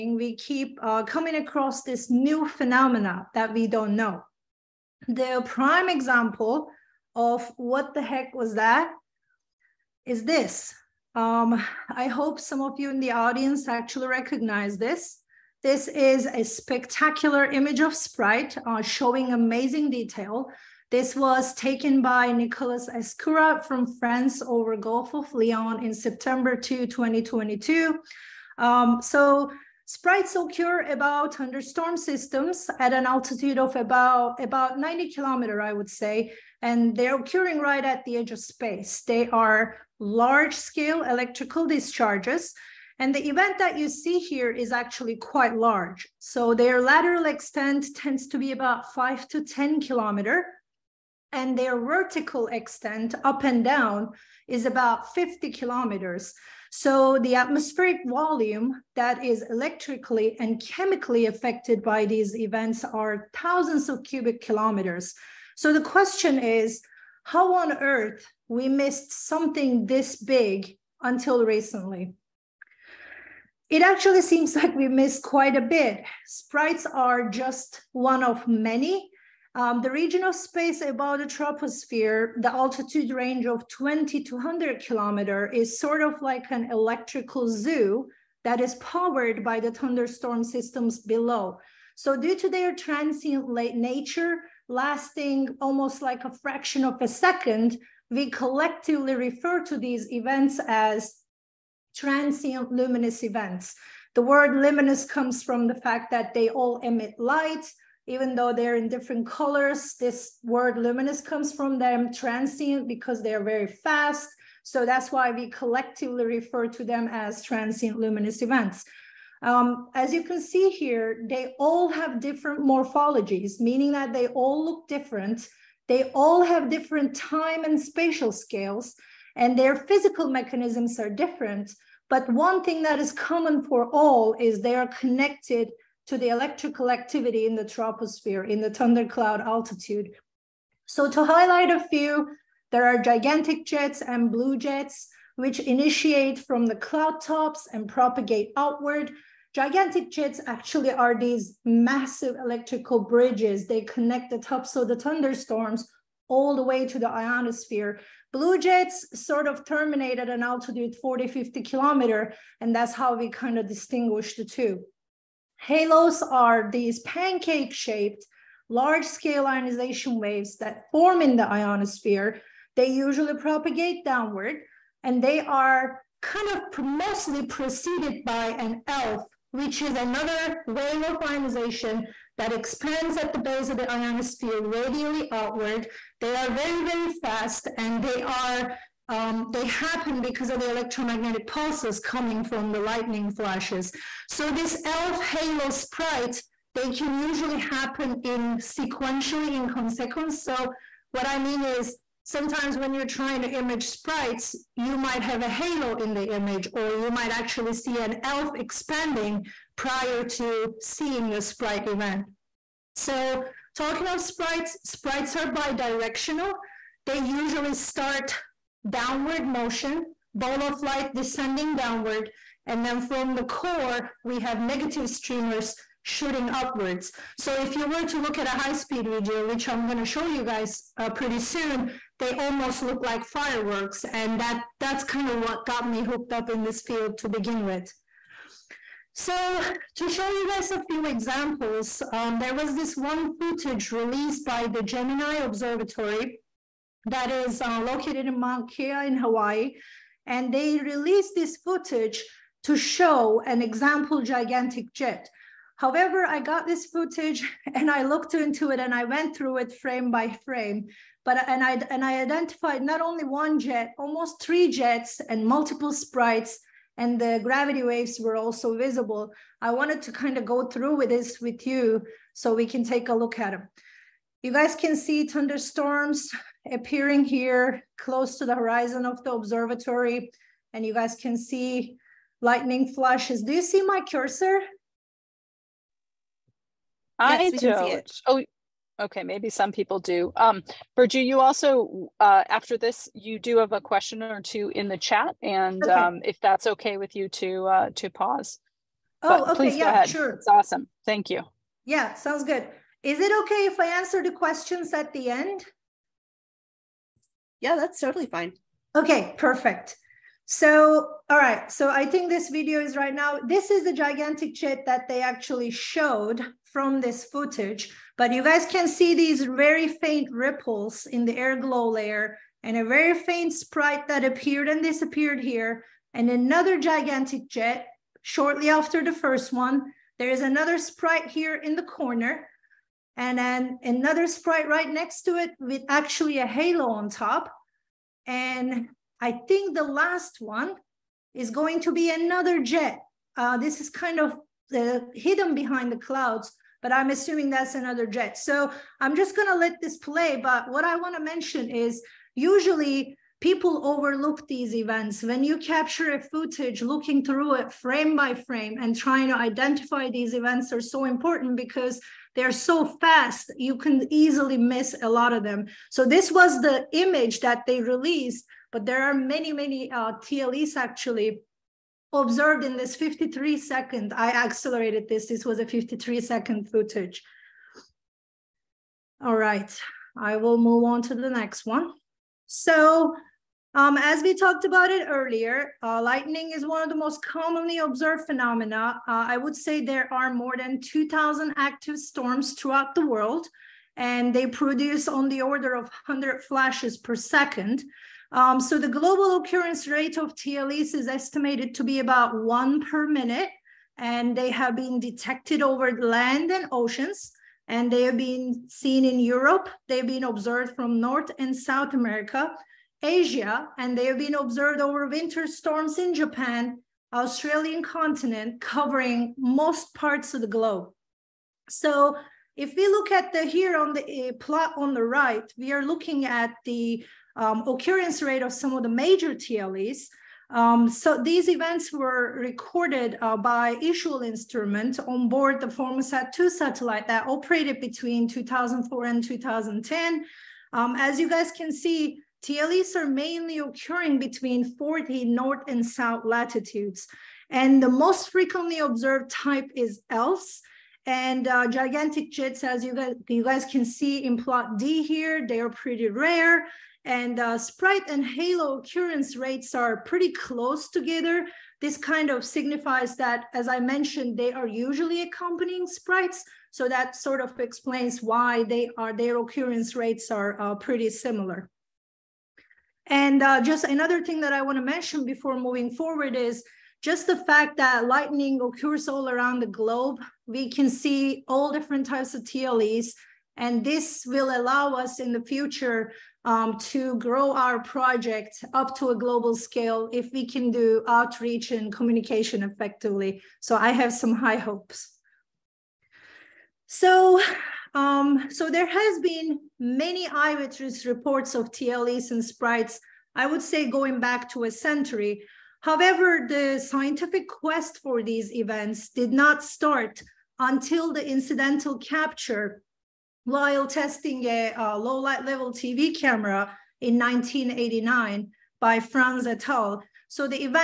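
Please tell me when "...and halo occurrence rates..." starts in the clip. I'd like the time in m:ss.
7:38.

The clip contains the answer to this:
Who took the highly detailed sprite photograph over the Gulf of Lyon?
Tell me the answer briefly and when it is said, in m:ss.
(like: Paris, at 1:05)
Nicolas Escurat, at 0:22.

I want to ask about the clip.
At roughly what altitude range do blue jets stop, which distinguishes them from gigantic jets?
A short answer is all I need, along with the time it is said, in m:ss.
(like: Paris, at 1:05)
40 to 50 kilometers, at 2:40.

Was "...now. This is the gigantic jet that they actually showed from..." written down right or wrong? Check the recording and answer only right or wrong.
right.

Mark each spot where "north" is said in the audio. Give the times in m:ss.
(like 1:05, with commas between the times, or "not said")
6:50, 7:25.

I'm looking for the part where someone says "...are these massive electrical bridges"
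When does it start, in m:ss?
2:30.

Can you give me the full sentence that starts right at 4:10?
And they released this footage to show an example gigantic jet.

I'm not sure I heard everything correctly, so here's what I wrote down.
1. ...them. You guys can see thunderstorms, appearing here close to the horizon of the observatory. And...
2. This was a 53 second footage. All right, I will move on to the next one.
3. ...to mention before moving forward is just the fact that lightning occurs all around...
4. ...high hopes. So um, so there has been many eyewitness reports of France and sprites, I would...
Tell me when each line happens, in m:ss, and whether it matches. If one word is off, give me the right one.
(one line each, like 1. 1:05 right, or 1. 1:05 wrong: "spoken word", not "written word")
1. 4:33 right
2. 6:15 right
3. 7:54 right
4. 8:14 wrong: "TLEs", not "France".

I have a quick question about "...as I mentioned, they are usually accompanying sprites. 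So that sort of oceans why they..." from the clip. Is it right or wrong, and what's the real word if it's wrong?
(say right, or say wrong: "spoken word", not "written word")
wrong: "explains", not "oceans".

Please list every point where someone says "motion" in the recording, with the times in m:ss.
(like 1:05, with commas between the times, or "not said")
3:39.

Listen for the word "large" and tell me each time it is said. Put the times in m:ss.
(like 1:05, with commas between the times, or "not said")
0:39, 0:45, 2:48.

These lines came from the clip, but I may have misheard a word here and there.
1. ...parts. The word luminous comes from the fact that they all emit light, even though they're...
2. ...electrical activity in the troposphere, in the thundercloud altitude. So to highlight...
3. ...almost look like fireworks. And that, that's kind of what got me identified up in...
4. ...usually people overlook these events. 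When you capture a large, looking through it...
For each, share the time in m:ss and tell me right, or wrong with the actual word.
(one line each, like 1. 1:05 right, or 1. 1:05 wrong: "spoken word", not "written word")
1. 1:43 wrong: "events", not "parts"
2. 2:16 right
3. 3:52 wrong: "hooked", not "identified"
4. 5:52 wrong: "footage", not "large".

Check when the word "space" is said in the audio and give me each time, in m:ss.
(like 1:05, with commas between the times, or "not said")
0:38, 1:20.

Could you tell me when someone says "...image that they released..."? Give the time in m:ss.
6:06.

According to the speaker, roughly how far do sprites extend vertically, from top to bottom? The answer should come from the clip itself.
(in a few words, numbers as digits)
50 kilometers.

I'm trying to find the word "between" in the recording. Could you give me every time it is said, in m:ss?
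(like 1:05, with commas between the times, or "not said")
7:17, 7:24.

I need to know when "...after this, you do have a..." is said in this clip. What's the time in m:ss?
4:52.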